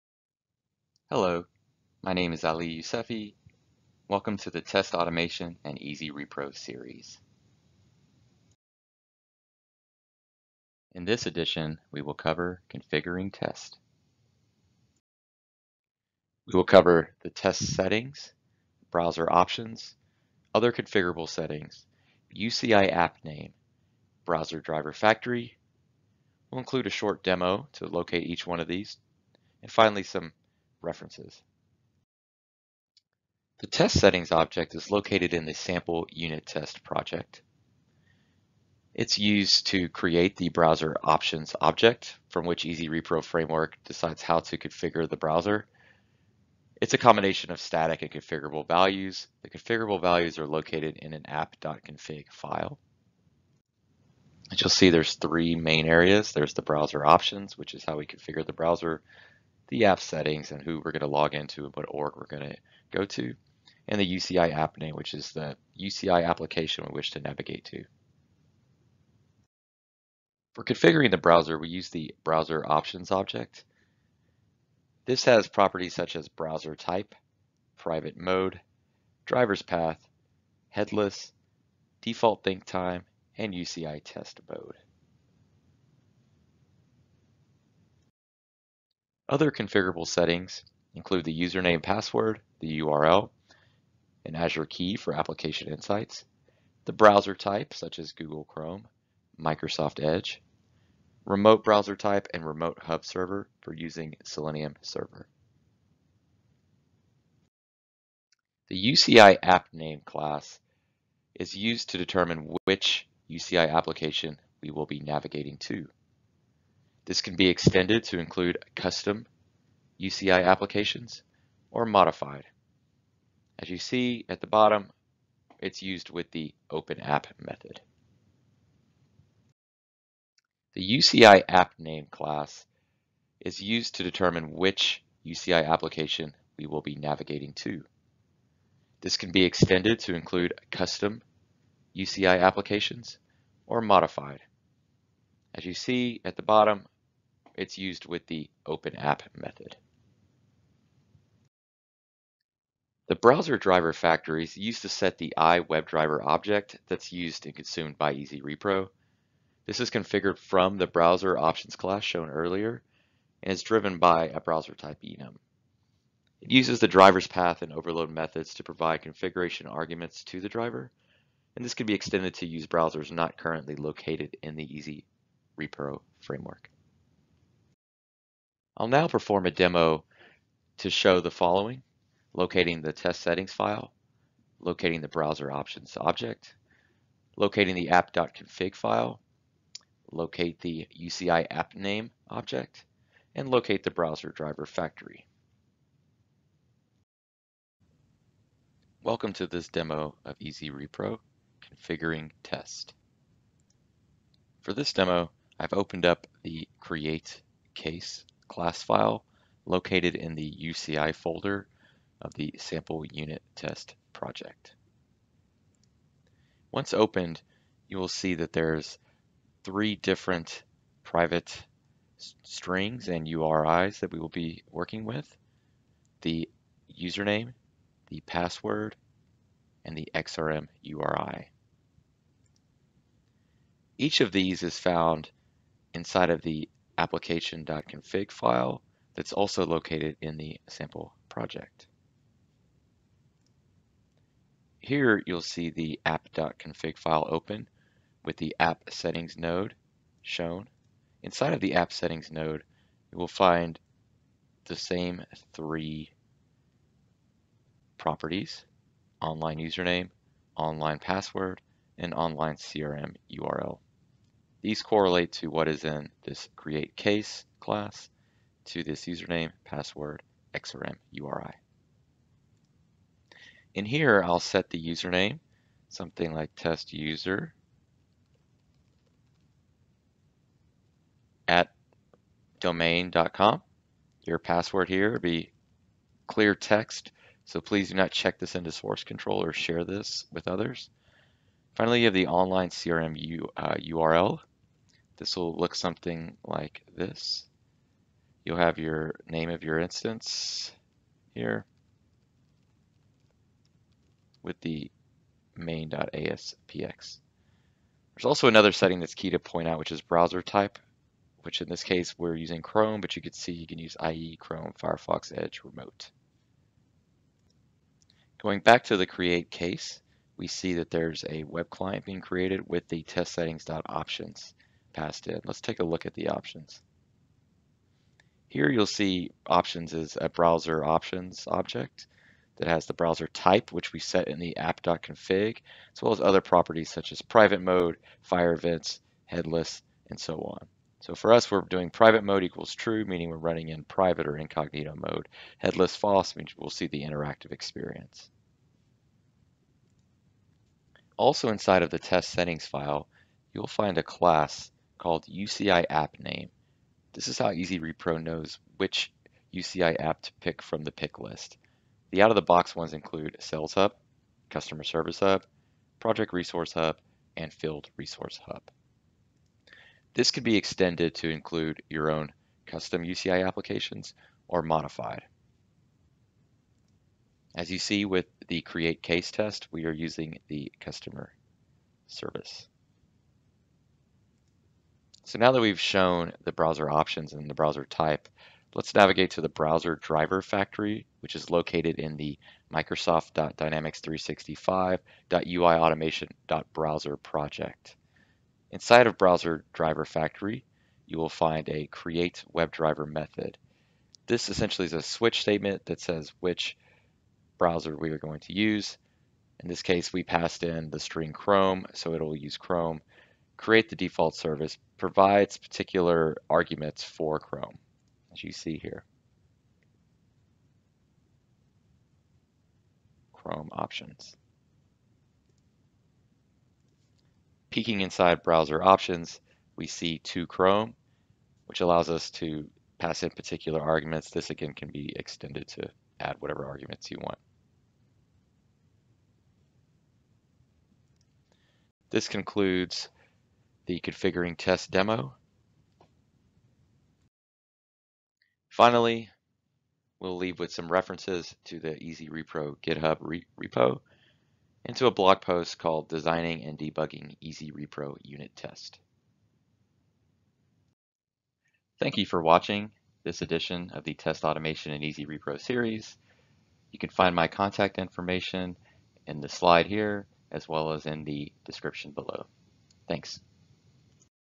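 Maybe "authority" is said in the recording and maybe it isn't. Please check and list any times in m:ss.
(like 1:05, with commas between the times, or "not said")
not said.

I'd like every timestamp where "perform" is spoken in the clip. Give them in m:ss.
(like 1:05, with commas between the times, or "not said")
2:59.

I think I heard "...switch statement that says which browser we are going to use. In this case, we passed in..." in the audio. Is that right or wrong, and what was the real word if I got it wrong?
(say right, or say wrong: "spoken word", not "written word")
right.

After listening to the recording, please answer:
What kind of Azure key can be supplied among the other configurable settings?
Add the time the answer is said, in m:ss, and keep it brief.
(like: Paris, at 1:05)
Application Insights, at 1:35.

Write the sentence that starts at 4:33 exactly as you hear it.
In here, I'll set the username, something like test user at domain.com.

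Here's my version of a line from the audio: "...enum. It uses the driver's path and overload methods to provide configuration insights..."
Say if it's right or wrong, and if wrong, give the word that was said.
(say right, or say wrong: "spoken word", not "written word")
wrong: "arguments", not "insights".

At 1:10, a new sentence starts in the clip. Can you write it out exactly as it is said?
For configuring the browser, we use the browser options object.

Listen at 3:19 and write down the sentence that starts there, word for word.
Welcome to this demo of Easy Repro, configuring test.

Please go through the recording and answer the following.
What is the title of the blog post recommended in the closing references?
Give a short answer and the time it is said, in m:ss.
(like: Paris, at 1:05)
Designing and Debugging Easy Repro Unit Test, at 7:36.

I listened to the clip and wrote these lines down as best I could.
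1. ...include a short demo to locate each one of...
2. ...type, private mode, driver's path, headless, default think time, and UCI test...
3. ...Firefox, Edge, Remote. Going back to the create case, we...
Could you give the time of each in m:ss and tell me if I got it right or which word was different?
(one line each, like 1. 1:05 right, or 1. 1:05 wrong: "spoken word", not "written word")
1. 0:26 right
2. 1:16 right
3. 5:14 right.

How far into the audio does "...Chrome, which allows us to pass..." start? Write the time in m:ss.
7:10.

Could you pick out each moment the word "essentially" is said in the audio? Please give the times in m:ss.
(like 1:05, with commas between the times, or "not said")
6:44.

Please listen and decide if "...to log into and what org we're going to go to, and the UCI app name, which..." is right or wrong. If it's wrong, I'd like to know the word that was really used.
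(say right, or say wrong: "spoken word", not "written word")
right.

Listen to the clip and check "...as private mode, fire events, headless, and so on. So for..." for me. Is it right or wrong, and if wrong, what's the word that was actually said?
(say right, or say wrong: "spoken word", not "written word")
right.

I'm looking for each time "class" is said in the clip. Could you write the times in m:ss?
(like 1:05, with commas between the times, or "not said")
1:50, 2:12, 2:41, 3:28, 4:27, 5:54.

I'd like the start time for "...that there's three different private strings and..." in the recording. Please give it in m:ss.
3:38.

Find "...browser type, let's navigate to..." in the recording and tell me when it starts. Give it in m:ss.
6:27.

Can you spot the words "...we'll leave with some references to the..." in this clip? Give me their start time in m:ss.
7:30.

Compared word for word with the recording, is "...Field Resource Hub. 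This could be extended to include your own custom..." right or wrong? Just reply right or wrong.
right.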